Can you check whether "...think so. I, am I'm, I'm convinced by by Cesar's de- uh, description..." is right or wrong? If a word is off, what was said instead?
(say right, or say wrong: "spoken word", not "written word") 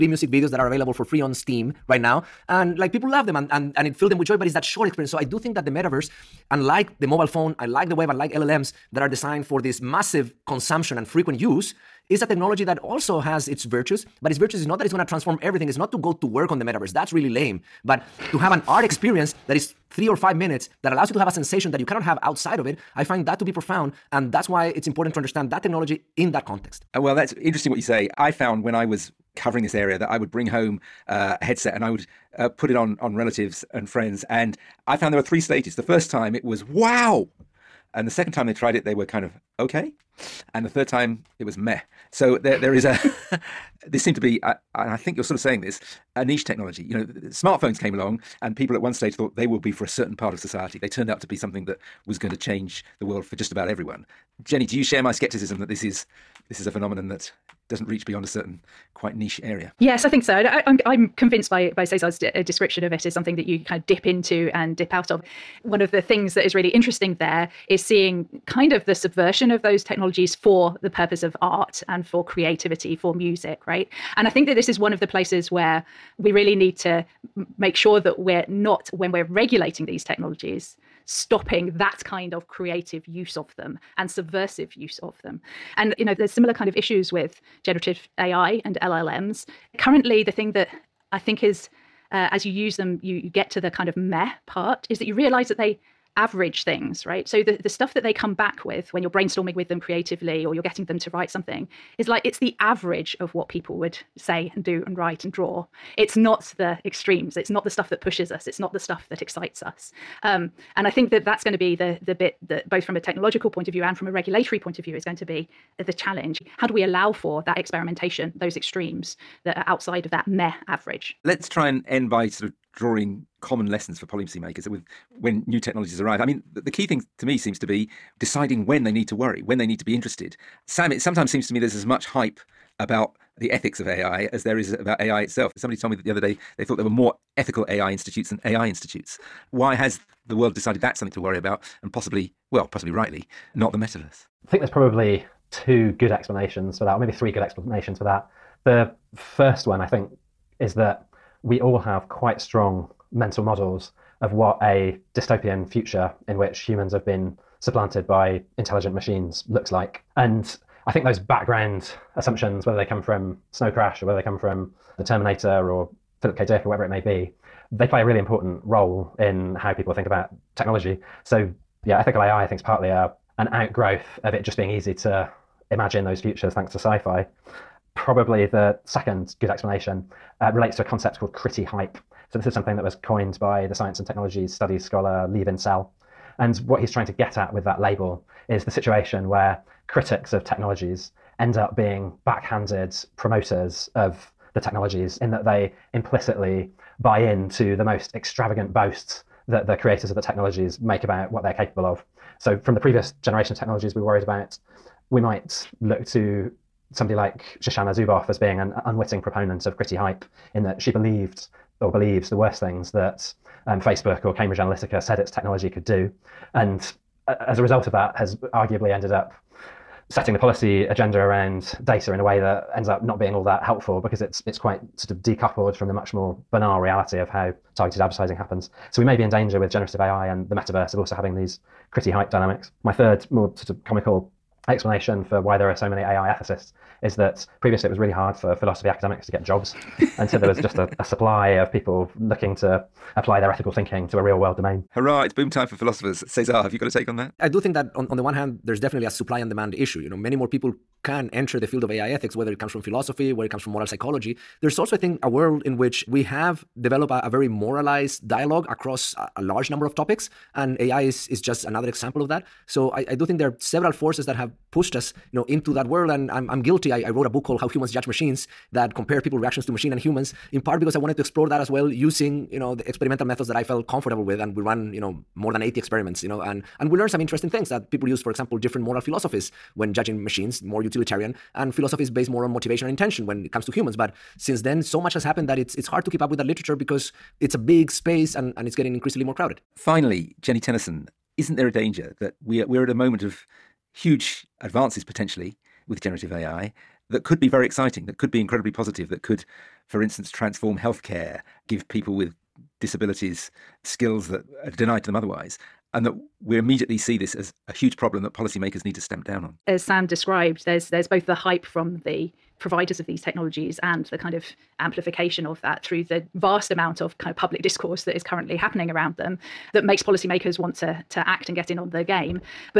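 right.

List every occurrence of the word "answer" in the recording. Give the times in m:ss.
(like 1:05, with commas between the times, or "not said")
not said.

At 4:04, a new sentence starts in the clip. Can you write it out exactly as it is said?
Hurrah, it's boom time for philosophers.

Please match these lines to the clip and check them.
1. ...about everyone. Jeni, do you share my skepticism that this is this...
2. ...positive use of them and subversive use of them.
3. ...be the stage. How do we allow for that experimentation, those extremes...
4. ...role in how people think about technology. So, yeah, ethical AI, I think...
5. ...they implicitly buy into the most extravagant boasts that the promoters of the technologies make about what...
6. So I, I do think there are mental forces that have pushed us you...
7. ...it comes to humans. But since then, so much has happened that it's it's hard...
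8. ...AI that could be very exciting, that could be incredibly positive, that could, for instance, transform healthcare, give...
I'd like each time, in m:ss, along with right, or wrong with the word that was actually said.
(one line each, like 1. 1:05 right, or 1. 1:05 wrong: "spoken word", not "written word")
1. 0:53 right
2. 1:22 wrong: "creative", not "positive"
3. 1:55 wrong: "challenge", not "stage"
4. 2:48 right
5. 3:15 wrong: "creators", not "promoters"
6. 4:22 wrong: "several", not "mental"
7. 4:43 right
8. 4:56 right.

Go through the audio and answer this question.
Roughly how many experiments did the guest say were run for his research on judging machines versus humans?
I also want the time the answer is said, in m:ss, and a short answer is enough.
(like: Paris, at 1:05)
more than 80, at 4:35.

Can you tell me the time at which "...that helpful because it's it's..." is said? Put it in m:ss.
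3:43.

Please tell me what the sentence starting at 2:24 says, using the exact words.
I think there's probably two good explanations for that, or maybe three good explanations for that.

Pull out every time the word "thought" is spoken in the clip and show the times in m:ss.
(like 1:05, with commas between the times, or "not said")
0:49, 2:16.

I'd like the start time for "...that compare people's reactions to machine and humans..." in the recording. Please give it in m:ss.
4:28.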